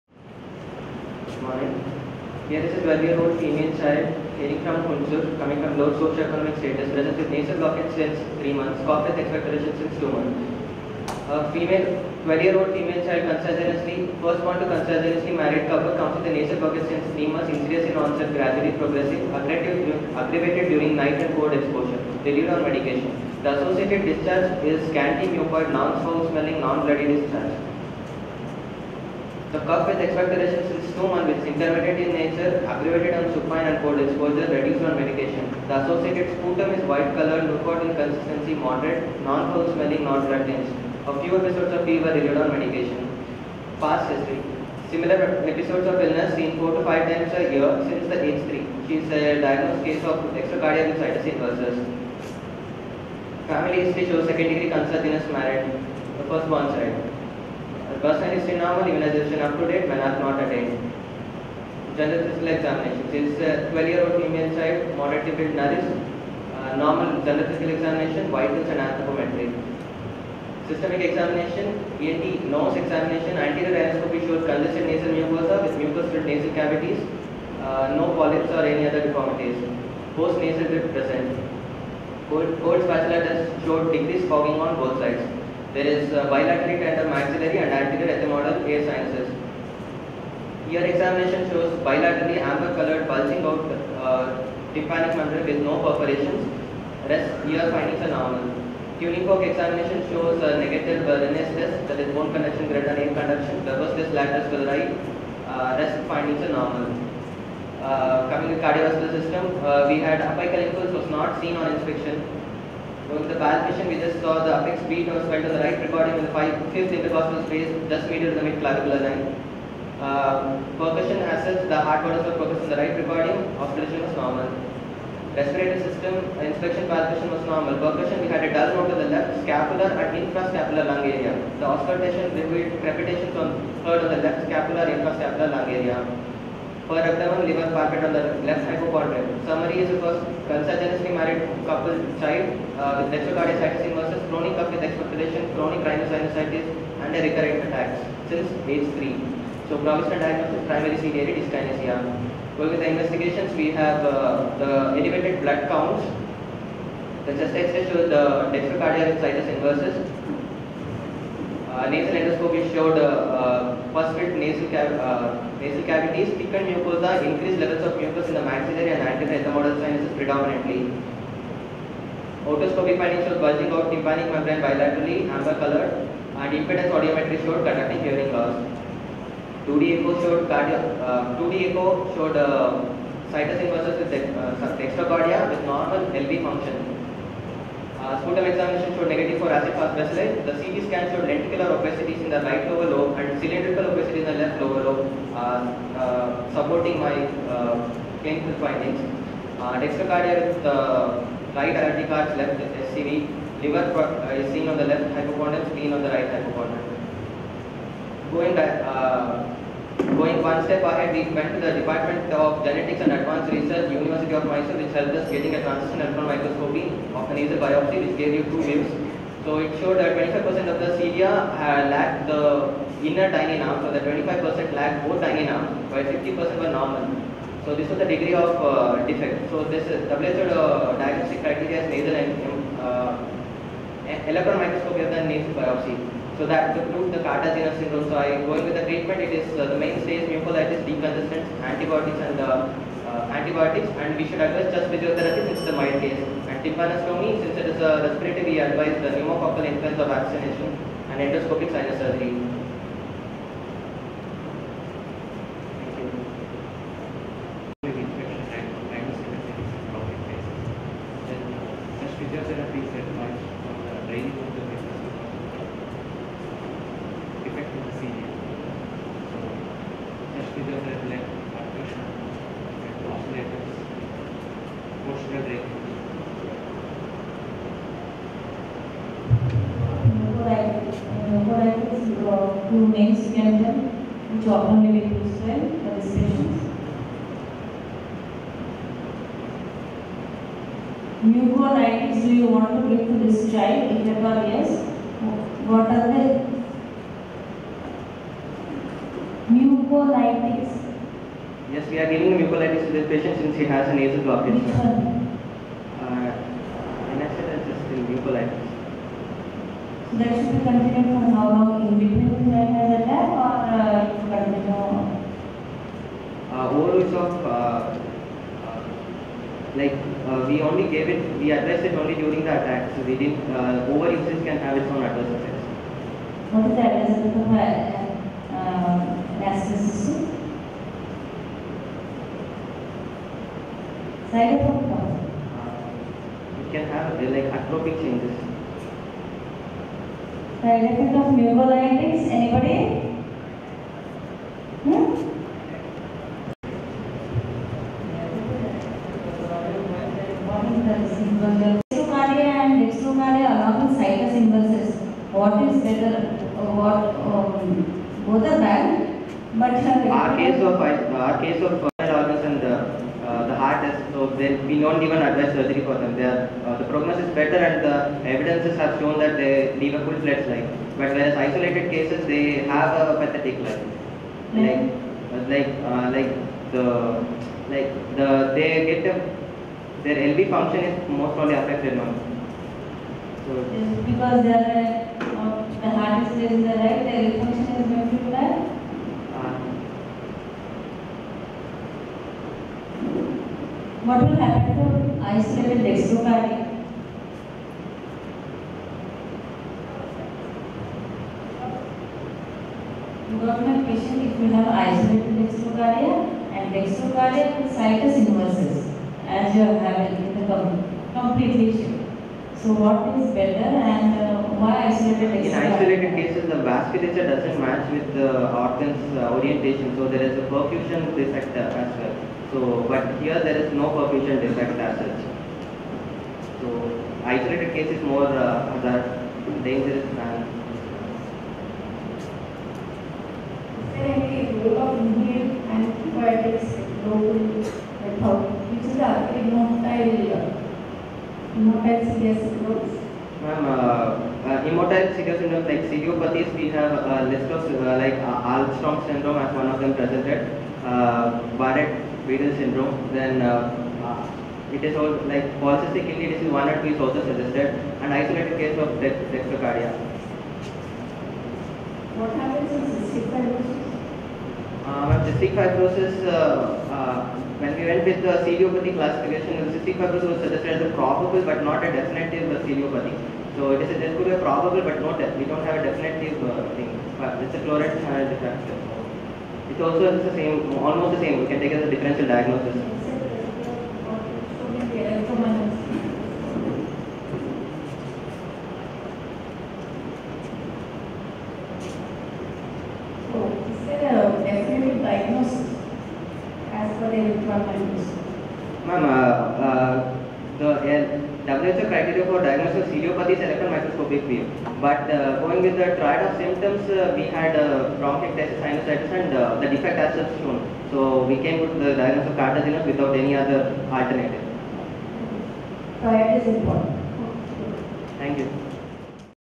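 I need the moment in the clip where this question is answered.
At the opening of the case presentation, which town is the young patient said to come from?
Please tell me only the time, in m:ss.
0:04.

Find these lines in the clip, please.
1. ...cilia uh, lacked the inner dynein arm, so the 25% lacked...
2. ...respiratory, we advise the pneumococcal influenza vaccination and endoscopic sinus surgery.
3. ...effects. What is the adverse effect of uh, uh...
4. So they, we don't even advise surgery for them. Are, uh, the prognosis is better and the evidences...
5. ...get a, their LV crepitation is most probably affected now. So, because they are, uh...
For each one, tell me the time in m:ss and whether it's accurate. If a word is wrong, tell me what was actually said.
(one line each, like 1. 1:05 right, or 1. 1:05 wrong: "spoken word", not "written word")
1. 3:40 right
2. 4:08 right
3. 5:25 right
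4. 6:04 right
5. 6:18 wrong: "function", not "crepitation".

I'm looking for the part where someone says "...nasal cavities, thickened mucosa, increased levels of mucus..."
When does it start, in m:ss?
2:45.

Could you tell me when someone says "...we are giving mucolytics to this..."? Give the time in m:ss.
5:01.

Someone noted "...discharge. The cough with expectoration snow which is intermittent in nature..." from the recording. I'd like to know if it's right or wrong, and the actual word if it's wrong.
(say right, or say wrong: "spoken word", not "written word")
right.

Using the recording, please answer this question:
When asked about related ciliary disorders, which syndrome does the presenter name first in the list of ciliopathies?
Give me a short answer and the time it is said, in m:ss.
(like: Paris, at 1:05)
Alström syndrome, at 7:28.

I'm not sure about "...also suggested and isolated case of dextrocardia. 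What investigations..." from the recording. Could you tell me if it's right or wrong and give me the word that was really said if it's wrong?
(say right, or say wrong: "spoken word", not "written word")
wrong: "happens", not "investigations".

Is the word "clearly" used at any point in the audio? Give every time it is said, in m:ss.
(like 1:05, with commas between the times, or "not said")
not said.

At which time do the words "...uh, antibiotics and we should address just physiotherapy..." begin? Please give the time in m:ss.
4:03.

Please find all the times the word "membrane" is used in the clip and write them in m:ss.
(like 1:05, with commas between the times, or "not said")
1:35, 2:54.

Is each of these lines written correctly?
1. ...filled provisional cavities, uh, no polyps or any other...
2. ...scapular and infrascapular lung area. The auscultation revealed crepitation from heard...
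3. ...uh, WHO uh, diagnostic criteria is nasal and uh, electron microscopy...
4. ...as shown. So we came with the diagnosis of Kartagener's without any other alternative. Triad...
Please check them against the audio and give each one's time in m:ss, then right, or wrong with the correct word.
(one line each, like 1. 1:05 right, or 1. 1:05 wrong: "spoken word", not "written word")
1. 1:16 wrong: "nasal", not "provisional"
2. 2:09 right
3. 3:49 right
4. 8:29 right.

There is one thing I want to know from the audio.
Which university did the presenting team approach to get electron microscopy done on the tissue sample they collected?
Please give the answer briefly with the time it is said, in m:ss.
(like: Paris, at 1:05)
University of Mysore, at 3:33.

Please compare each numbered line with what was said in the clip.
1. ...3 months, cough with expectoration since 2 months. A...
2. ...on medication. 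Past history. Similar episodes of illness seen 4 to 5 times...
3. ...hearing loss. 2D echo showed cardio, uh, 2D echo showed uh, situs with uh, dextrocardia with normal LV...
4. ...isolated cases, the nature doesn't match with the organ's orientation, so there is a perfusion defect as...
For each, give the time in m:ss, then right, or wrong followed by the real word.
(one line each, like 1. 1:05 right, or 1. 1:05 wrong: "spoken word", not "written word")
1. 0:08 right
2. 0:42 right
3. 2:58 right
4. 6:55 wrong: "vasculature", not "nature".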